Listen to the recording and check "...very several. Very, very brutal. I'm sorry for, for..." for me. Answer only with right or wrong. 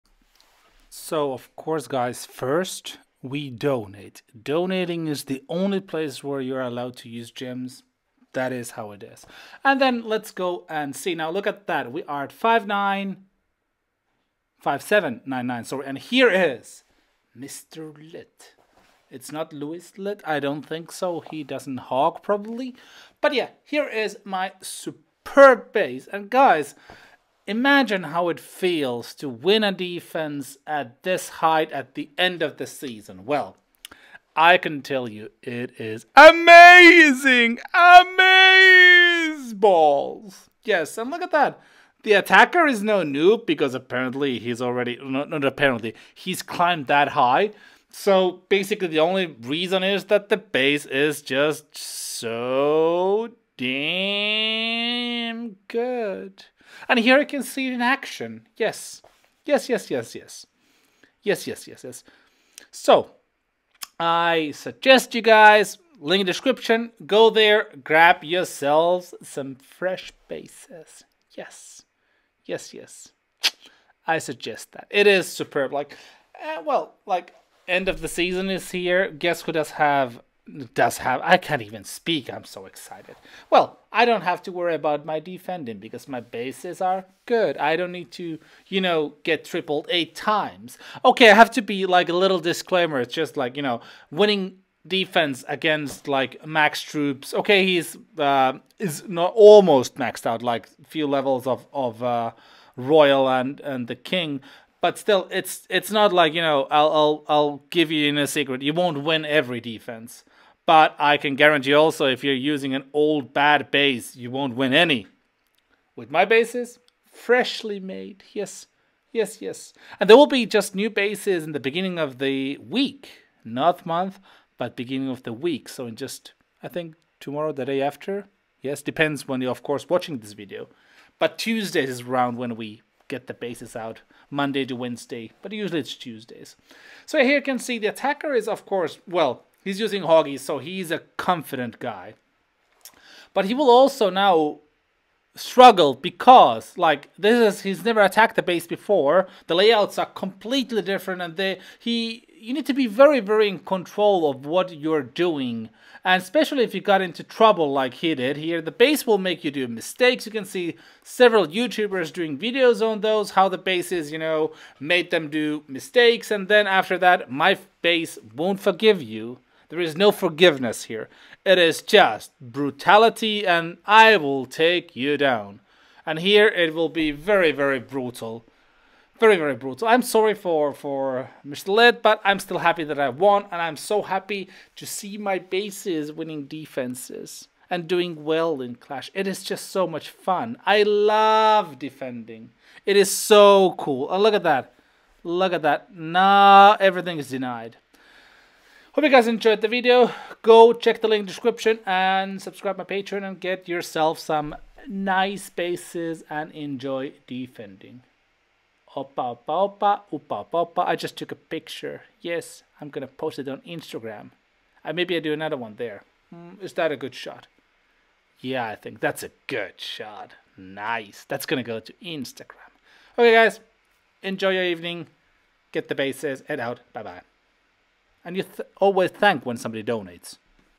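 wrong.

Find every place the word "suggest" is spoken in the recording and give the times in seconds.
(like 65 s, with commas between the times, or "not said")
64 s, 74 s.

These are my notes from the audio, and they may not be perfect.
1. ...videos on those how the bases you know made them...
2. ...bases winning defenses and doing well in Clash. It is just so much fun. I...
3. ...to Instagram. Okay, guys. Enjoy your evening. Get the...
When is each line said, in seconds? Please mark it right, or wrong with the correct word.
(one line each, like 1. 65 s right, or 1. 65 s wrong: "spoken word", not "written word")
1. 162 s right
2. 185 s right
3. 221 s right.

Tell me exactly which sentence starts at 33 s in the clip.
Well, I can tell you it is amazing!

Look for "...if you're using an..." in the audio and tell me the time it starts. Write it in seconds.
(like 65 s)
112 s.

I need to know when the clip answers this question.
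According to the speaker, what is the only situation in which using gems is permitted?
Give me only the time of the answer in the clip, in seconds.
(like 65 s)
4 s.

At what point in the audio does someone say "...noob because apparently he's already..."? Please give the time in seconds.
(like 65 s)
43 s.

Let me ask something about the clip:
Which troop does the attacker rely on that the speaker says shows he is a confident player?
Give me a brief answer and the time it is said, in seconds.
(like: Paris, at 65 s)
Hoggy, at 140 s.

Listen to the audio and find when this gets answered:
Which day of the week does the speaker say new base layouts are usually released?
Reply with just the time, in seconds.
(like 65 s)
135 s.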